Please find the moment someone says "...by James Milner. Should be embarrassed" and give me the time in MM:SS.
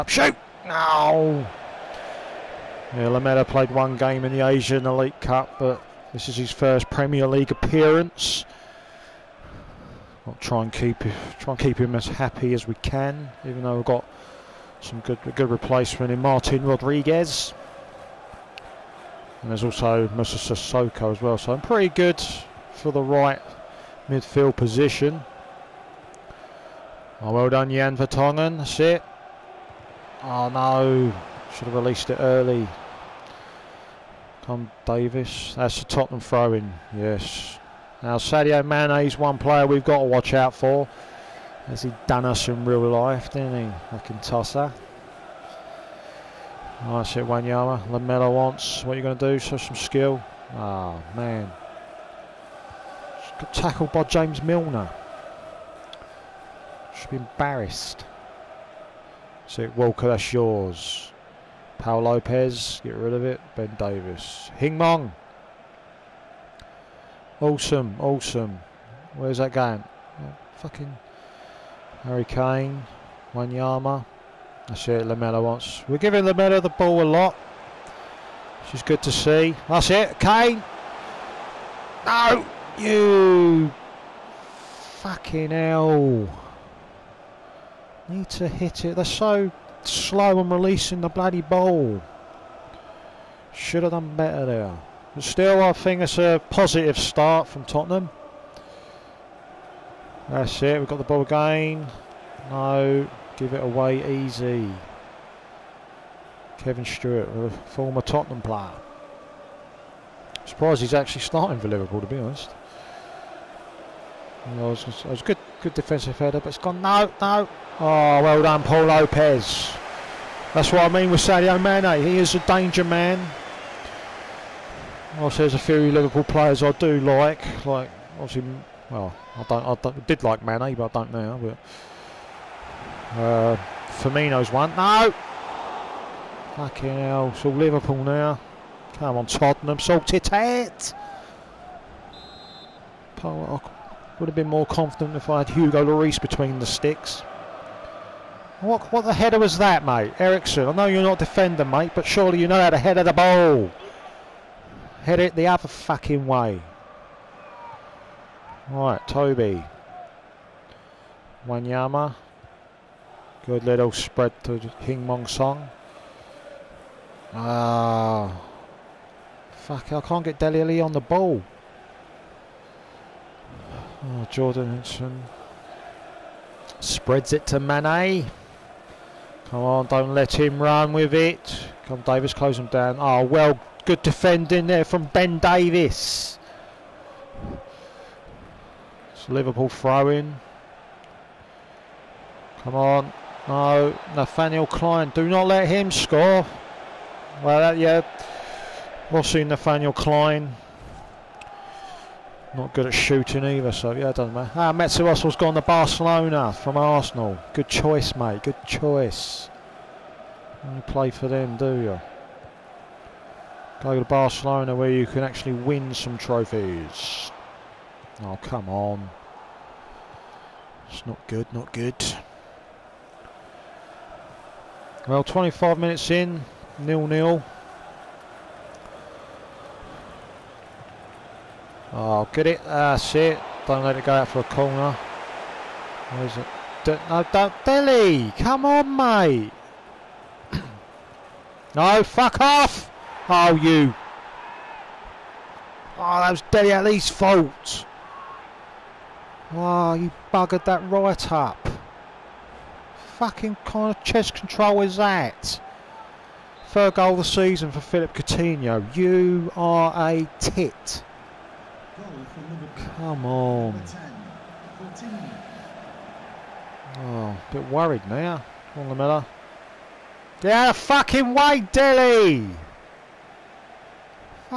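00:53.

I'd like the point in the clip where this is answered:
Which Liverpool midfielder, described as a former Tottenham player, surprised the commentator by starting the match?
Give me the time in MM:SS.
01:46.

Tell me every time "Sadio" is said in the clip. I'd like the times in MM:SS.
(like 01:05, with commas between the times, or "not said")
00:38, 02:01.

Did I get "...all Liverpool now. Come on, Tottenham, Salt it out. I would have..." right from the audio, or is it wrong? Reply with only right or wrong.
right.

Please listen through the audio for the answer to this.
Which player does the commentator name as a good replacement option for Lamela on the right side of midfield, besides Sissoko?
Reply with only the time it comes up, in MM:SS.
00:16.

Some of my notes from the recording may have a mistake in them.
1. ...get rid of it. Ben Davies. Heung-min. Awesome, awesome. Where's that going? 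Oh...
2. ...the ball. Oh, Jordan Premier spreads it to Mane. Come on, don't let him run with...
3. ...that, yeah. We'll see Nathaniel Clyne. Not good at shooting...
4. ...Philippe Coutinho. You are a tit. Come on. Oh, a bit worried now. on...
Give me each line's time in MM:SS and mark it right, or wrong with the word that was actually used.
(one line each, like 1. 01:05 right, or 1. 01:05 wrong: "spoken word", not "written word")
1. 01:02 right
2. 02:50 wrong: "Henderson", not "Premier"
3. 03:17 right
4. 04:17 right.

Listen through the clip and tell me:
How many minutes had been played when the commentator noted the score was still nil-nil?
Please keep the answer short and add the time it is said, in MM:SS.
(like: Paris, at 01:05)
25, at 03:45.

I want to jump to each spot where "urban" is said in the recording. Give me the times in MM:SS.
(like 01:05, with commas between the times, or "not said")
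not said.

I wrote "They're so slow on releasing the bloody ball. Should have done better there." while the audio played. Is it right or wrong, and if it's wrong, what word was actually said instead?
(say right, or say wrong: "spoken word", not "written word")
right.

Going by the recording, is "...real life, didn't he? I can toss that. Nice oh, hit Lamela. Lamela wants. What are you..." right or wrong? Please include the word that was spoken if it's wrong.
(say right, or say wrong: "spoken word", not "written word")
wrong: "Wanyama", not "Lamela".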